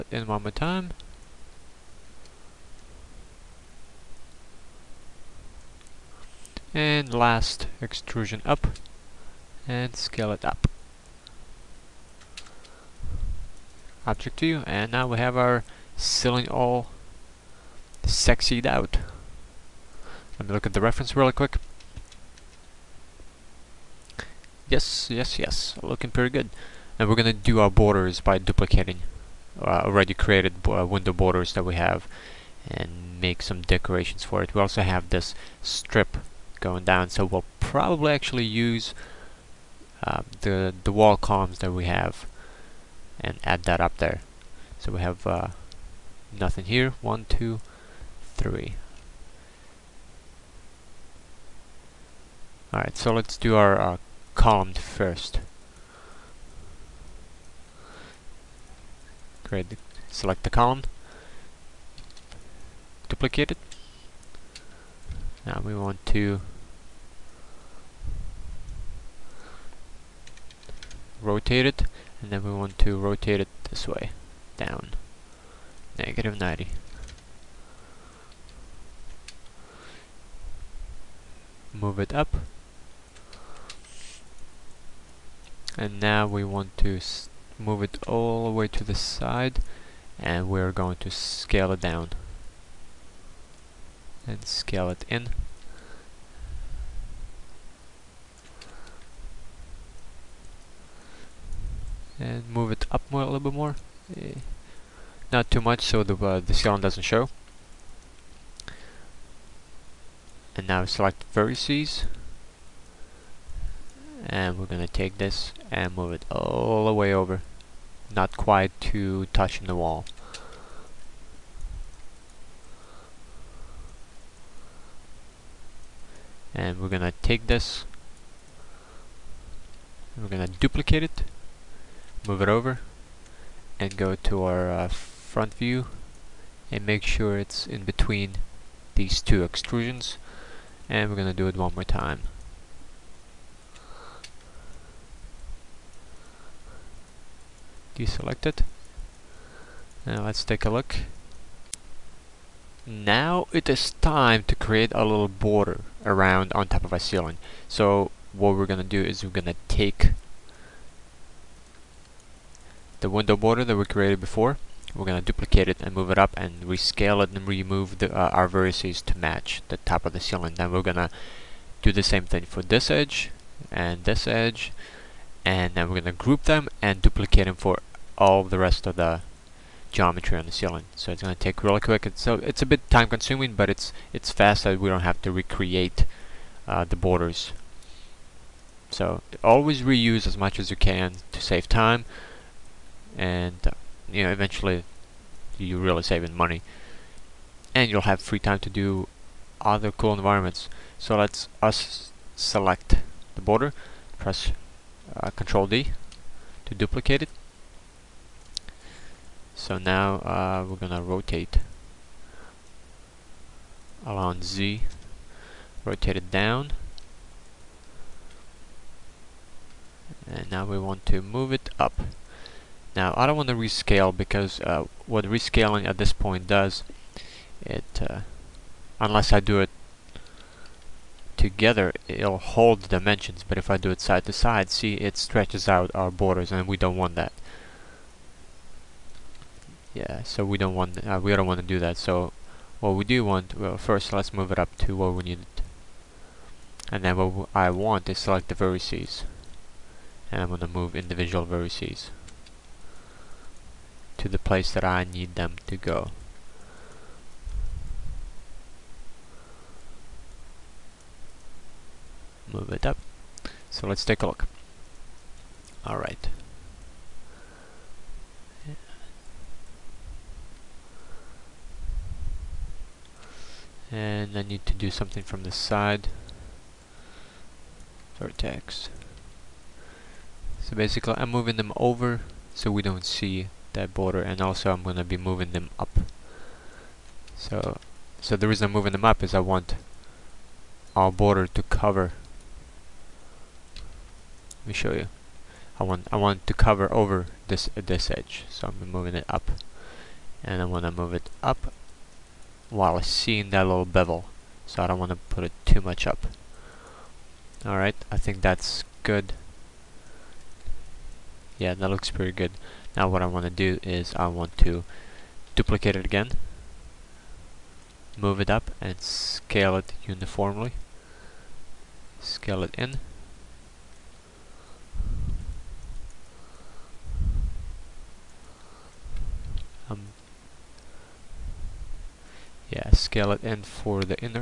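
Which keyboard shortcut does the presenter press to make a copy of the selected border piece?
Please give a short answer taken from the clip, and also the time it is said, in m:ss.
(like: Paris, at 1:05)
Control D, at 3:25.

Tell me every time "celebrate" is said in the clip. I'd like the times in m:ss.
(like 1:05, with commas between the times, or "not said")
not said.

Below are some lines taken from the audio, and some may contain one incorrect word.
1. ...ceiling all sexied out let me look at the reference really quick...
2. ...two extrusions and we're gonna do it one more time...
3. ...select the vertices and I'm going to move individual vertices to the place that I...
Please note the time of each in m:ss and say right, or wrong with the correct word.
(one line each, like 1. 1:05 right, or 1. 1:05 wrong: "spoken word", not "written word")
1. 0:15 right
2. 2:19 right
3. 4:08 right.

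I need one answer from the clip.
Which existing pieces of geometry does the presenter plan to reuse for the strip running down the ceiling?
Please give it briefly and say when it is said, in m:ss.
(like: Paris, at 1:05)
wall columns, at 0:40.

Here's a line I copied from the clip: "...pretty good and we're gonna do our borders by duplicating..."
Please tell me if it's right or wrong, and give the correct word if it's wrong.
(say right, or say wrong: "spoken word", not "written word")
right.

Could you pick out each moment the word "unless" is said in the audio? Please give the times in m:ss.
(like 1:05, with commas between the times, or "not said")
3:48.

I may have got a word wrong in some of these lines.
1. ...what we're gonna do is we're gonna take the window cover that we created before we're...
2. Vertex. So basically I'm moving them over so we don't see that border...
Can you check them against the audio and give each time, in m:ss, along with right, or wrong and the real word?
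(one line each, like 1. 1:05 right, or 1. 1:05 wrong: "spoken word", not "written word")
1. 2:38 wrong: "border", not "cover"
2. 4:38 right.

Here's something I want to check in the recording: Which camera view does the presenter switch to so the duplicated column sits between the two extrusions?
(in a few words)
front view.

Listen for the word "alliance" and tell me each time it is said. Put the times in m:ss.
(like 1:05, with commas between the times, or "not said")
not said.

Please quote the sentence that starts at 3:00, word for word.
So it's going to take really quick.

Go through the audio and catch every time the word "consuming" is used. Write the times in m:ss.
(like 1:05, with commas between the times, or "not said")
3:03.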